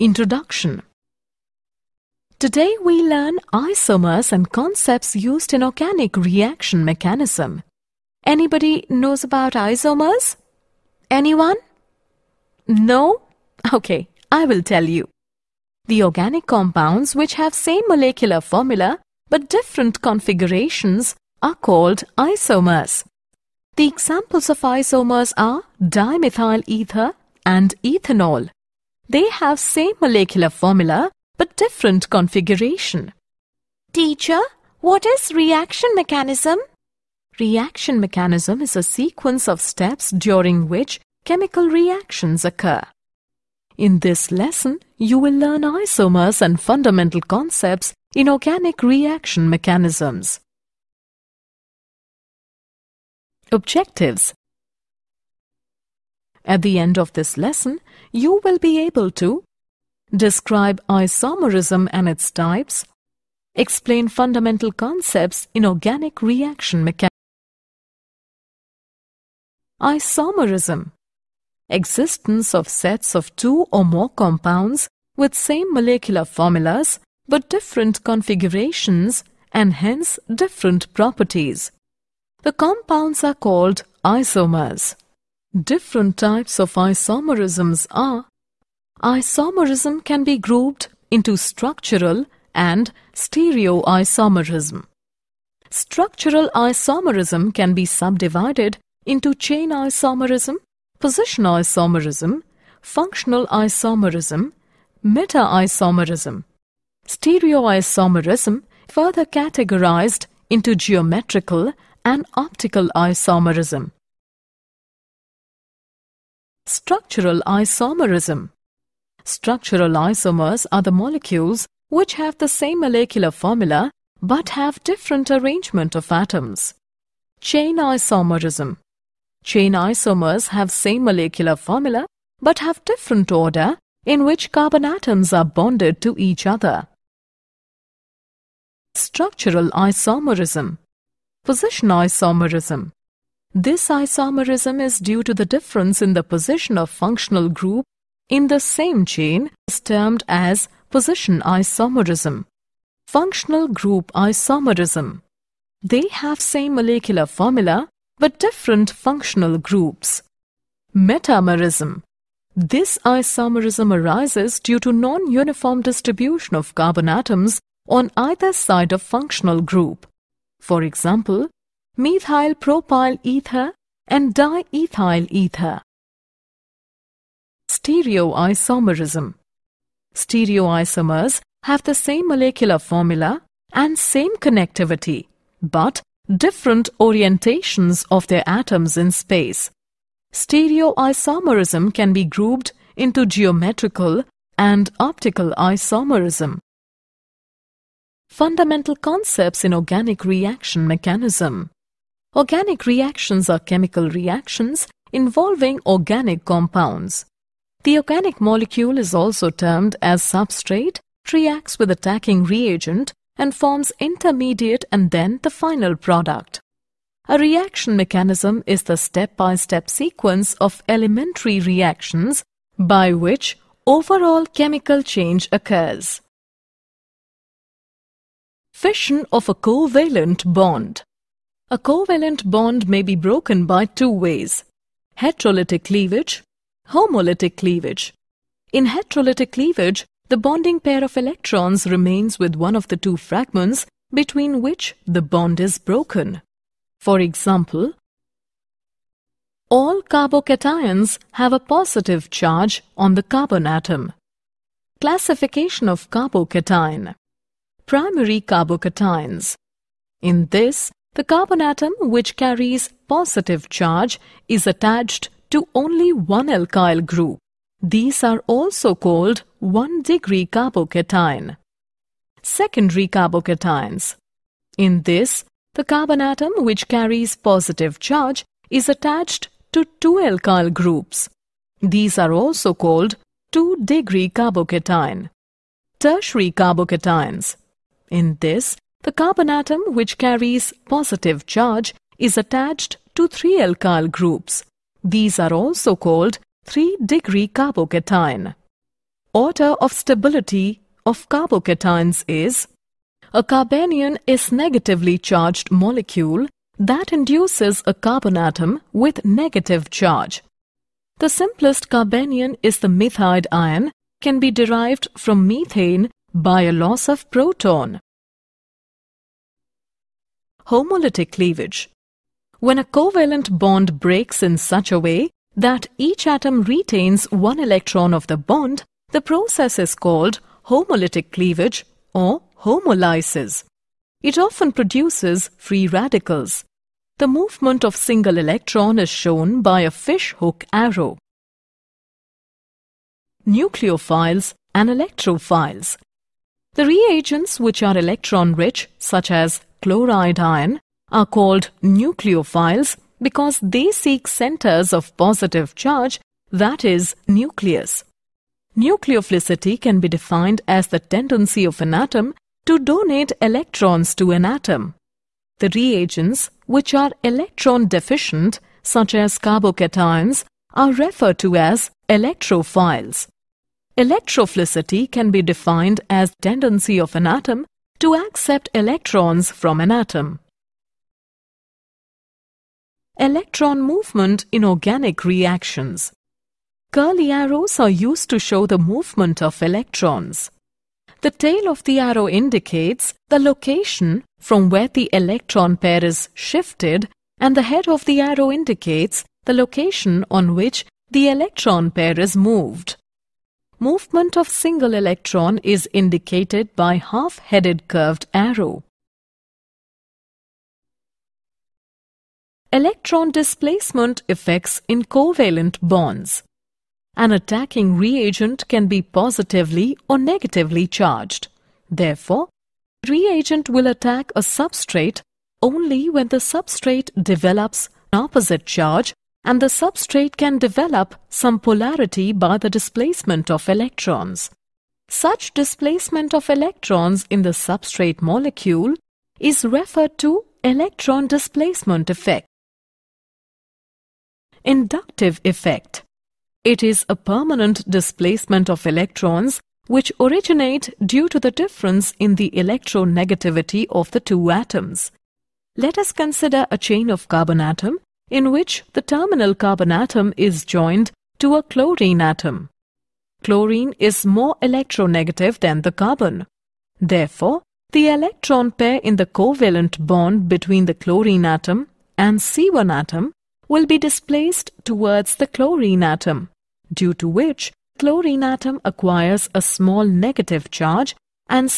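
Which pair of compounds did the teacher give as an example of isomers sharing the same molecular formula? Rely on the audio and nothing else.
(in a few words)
dimethyl ether and ethanol.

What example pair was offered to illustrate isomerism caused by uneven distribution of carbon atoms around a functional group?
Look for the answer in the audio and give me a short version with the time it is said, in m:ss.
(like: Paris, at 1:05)
methyl propyl ether and diethyl ether, at 2:51.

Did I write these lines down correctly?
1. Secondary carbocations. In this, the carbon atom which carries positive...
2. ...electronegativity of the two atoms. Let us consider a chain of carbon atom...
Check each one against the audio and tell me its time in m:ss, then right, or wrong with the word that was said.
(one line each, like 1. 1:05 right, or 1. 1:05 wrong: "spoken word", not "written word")
1. 4:32 right
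2. 7:32 right.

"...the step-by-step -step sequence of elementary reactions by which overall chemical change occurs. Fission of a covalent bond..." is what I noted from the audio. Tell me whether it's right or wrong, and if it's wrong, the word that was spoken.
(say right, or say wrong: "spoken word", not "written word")
right.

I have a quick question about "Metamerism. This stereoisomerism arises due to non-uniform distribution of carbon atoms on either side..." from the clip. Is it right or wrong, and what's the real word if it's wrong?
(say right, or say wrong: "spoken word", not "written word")
wrong: "isomerism", not "stereoisomerism".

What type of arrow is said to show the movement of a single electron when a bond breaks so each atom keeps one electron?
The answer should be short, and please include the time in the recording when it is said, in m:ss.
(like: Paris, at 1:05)
fishhook arrow, at 5:39.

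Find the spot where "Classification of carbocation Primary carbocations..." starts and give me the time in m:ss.
4:14.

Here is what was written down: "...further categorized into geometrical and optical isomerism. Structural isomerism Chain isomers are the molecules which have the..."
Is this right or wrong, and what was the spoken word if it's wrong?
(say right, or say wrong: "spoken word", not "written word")
wrong: "Structural", not "Chain".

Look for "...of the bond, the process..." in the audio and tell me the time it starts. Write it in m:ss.
5:28.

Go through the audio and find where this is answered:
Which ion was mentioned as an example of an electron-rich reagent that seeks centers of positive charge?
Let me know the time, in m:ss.
5:49.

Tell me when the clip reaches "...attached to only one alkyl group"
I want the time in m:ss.
4:24.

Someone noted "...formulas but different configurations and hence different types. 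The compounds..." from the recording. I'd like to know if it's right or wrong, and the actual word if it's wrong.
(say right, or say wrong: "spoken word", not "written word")
wrong: "properties", not "types".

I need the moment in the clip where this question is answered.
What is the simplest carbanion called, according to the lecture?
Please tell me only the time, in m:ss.
5:12.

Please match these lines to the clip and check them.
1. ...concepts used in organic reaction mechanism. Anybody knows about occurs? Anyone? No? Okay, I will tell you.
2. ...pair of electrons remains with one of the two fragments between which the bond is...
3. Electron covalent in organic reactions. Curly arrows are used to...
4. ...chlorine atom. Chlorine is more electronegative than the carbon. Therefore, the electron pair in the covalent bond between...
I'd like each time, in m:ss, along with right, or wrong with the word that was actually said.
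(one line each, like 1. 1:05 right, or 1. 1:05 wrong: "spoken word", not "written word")
1. 0:04 wrong: "isomers", not "occurs"
2. 4:00 right
3. 6:23 wrong: "movement", not "covalent"
4. 7:41 right.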